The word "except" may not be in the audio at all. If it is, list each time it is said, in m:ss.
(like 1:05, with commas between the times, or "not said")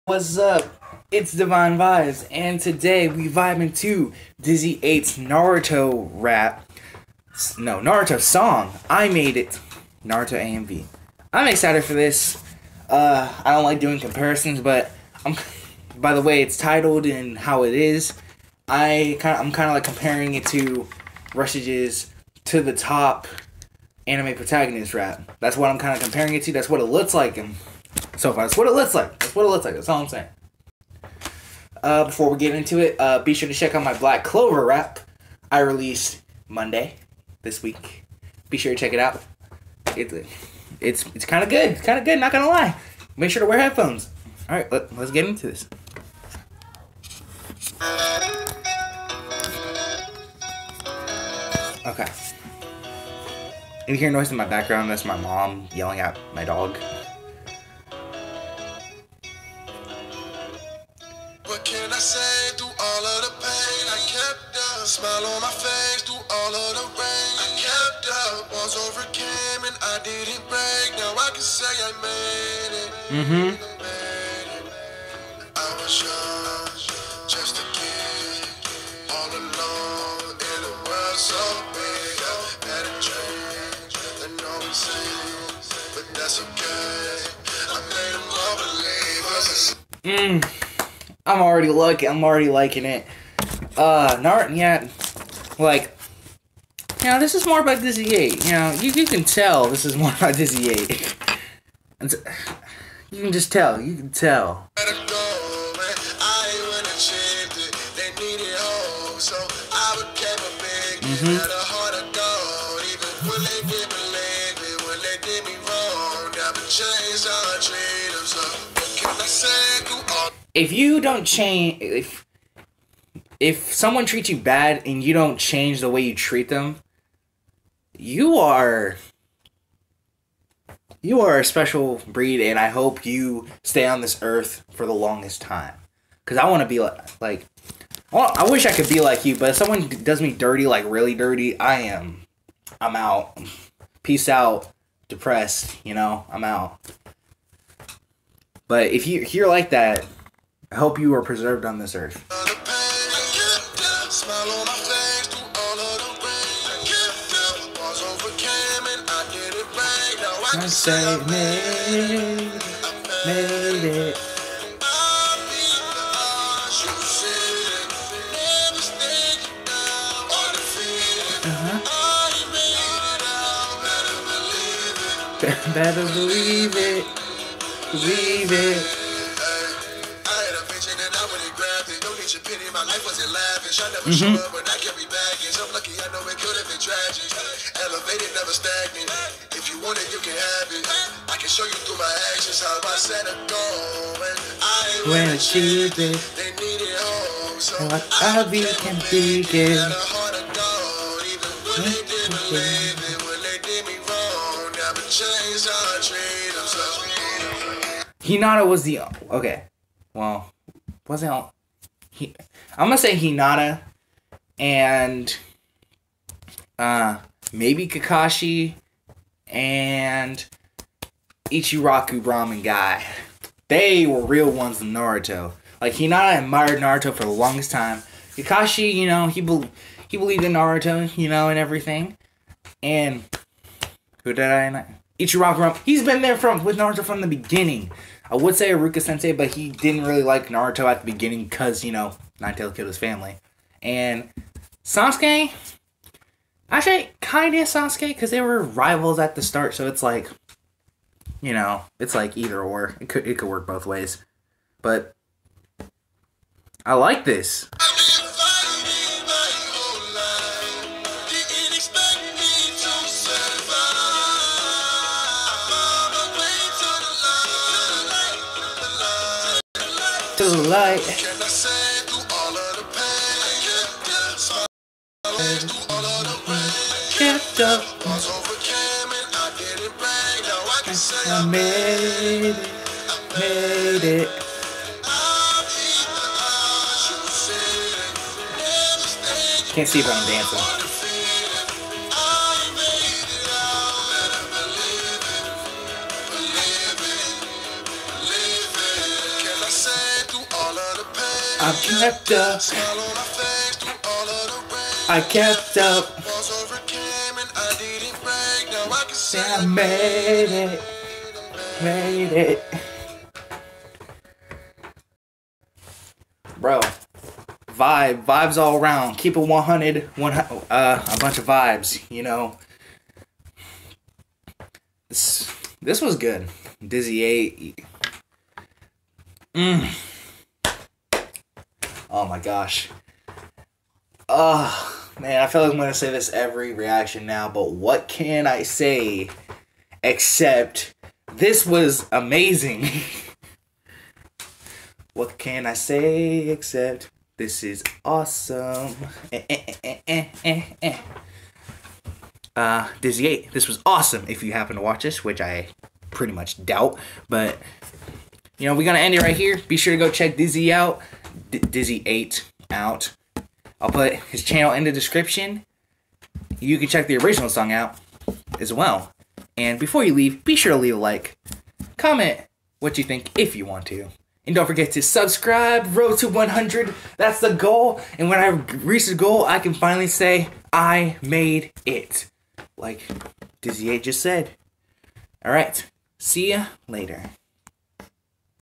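5:40, 5:46.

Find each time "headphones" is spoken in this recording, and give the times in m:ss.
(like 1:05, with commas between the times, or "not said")
0:43.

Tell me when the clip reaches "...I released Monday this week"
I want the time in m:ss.
0:35.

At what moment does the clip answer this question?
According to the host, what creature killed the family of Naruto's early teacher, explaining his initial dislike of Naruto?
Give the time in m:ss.
4:02.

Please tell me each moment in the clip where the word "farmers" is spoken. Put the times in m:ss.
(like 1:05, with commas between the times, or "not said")
not said.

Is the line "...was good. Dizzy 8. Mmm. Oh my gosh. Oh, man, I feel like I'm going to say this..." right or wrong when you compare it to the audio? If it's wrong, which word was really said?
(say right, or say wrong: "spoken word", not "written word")
right.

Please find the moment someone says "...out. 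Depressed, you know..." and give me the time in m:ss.
2:24.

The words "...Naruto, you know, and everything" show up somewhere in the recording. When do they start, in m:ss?
3:50.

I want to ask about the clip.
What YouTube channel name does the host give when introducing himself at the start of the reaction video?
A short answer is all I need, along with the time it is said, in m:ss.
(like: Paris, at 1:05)
Divine Vibes, at 0:01.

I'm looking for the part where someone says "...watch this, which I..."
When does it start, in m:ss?
5:54.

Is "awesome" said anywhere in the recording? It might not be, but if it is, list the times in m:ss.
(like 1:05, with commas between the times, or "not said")
5:48, 5:53.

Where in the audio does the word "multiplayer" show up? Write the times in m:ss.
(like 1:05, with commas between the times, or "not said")
not said.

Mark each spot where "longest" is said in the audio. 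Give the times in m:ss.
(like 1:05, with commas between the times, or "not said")
2:14, 3:47.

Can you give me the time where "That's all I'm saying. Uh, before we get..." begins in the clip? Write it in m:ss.
0:29.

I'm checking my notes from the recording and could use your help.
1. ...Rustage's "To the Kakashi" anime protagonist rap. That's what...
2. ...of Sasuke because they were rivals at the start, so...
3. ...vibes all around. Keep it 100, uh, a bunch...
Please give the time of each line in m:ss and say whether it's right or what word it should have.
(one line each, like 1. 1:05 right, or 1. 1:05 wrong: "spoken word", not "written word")
1. 0:21 wrong: "Top", not "Kakashi"
2. 4:07 right
3. 5:18 right.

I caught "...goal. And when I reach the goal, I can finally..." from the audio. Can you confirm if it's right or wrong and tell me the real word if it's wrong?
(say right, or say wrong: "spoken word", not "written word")
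right.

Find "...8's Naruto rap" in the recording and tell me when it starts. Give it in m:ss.
0:04.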